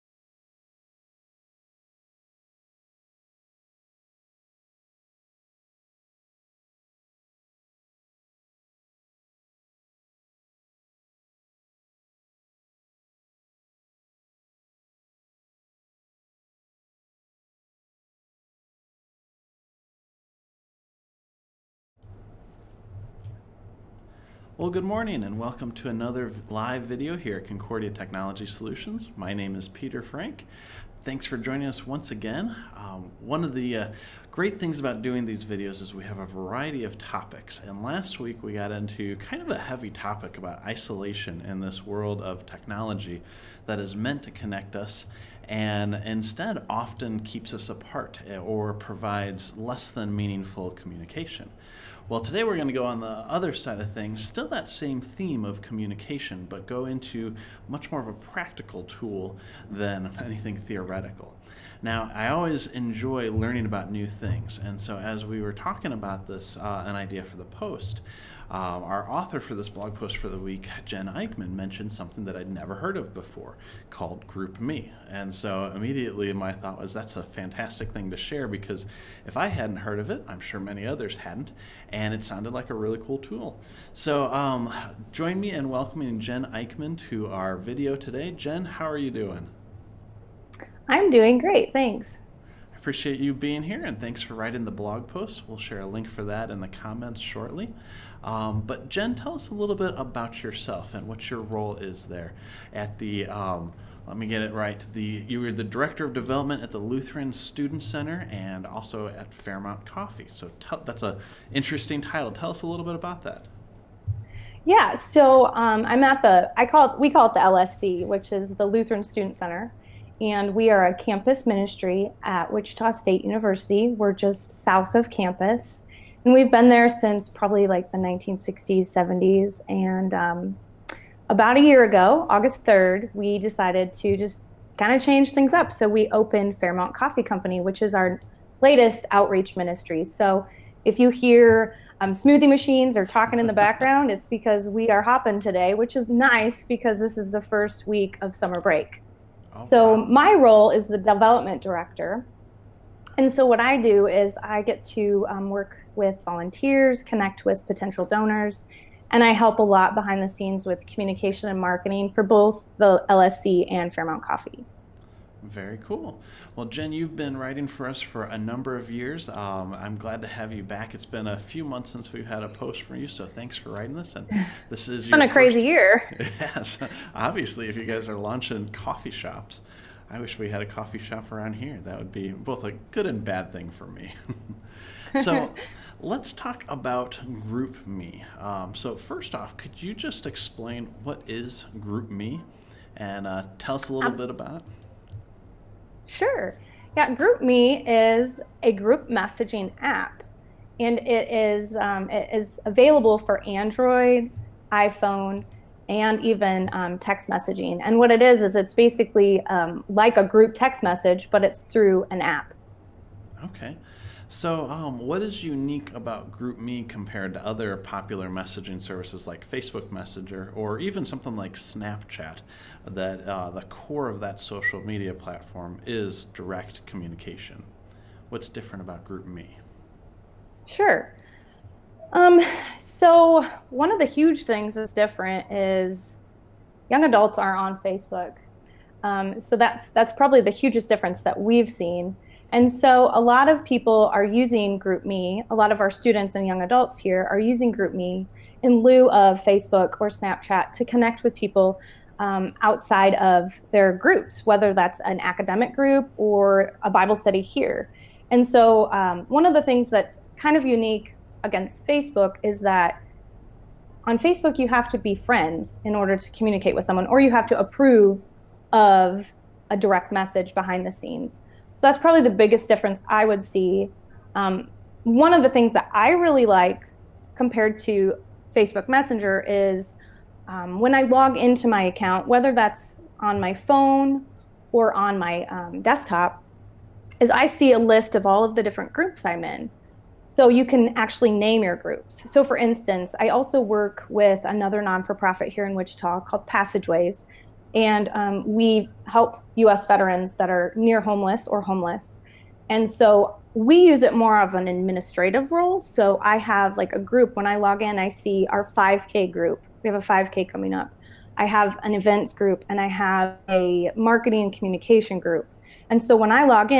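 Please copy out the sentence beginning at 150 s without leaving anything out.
my role is the development director.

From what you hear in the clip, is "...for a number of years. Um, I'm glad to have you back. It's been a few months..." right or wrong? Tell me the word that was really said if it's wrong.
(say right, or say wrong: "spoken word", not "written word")
right.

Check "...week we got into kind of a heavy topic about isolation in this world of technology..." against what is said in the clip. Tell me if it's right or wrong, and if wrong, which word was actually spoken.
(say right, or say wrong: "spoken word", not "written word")
right.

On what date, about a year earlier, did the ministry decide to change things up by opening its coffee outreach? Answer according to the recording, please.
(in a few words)
August 3rd.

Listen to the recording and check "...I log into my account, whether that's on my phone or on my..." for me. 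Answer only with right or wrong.
right.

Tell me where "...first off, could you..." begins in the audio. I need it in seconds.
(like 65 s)
188 s.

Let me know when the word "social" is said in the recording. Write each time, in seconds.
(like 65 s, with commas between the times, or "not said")
224 s.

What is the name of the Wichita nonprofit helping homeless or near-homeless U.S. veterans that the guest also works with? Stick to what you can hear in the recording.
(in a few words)
Passageways.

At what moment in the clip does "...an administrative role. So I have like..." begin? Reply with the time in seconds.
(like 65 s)
304 s.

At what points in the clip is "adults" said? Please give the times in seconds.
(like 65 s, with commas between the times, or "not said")
237 s, 246 s.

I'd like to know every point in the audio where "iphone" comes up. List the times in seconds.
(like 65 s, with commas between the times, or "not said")
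204 s.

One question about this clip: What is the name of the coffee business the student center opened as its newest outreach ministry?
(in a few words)
Fairmount Coffee Company.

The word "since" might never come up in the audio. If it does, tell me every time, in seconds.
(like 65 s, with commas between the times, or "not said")
126 s, 171 s.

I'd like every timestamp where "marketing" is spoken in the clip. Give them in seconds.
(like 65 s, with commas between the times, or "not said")
161 s, 313 s.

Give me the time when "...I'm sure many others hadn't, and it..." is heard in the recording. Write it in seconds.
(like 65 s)
80 s.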